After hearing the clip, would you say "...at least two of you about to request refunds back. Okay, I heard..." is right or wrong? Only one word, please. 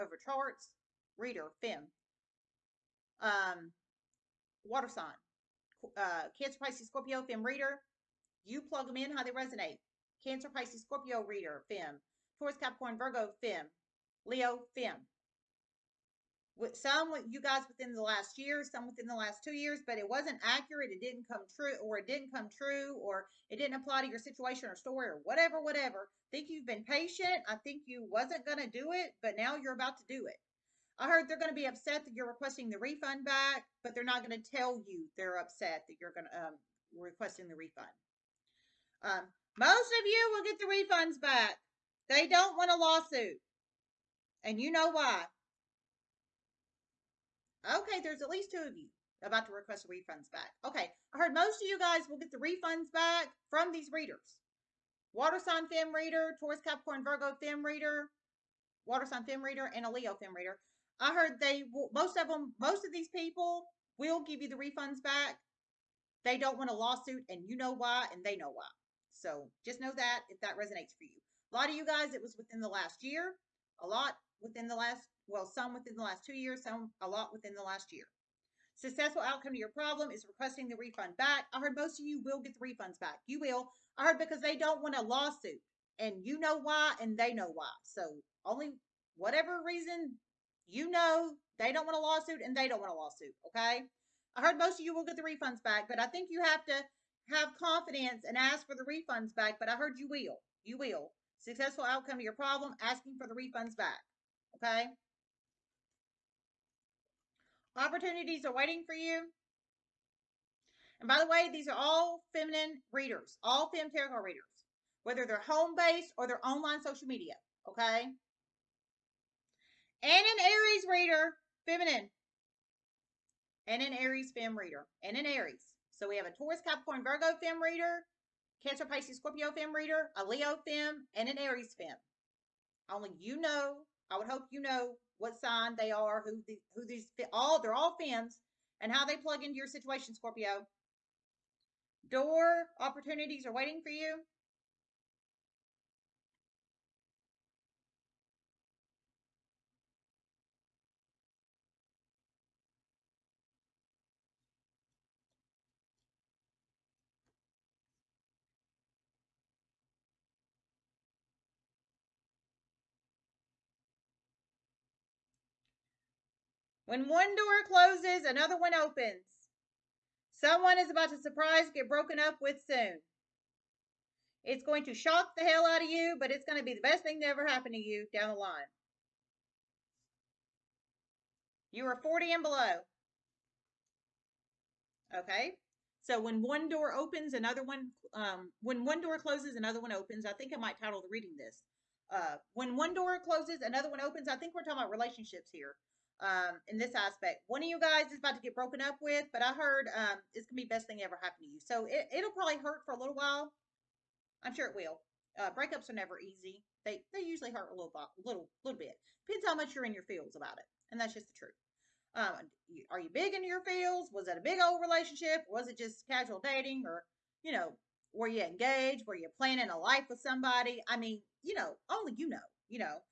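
right.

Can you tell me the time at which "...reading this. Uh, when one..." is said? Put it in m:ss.
3:11.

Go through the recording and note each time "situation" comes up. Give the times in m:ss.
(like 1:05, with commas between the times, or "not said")
0:24, 2:19.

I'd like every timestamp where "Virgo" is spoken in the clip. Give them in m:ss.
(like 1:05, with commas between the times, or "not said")
0:12, 0:57, 2:07.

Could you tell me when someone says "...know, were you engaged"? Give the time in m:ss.
3:37.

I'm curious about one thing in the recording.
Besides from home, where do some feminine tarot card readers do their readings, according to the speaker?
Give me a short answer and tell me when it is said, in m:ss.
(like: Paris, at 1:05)
Online social media, at 1:56.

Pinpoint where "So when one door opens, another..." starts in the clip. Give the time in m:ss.
3:06.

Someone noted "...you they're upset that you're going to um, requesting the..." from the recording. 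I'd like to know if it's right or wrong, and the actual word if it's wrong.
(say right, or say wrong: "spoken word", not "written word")
right.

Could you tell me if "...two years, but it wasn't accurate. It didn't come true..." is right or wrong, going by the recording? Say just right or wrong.
right.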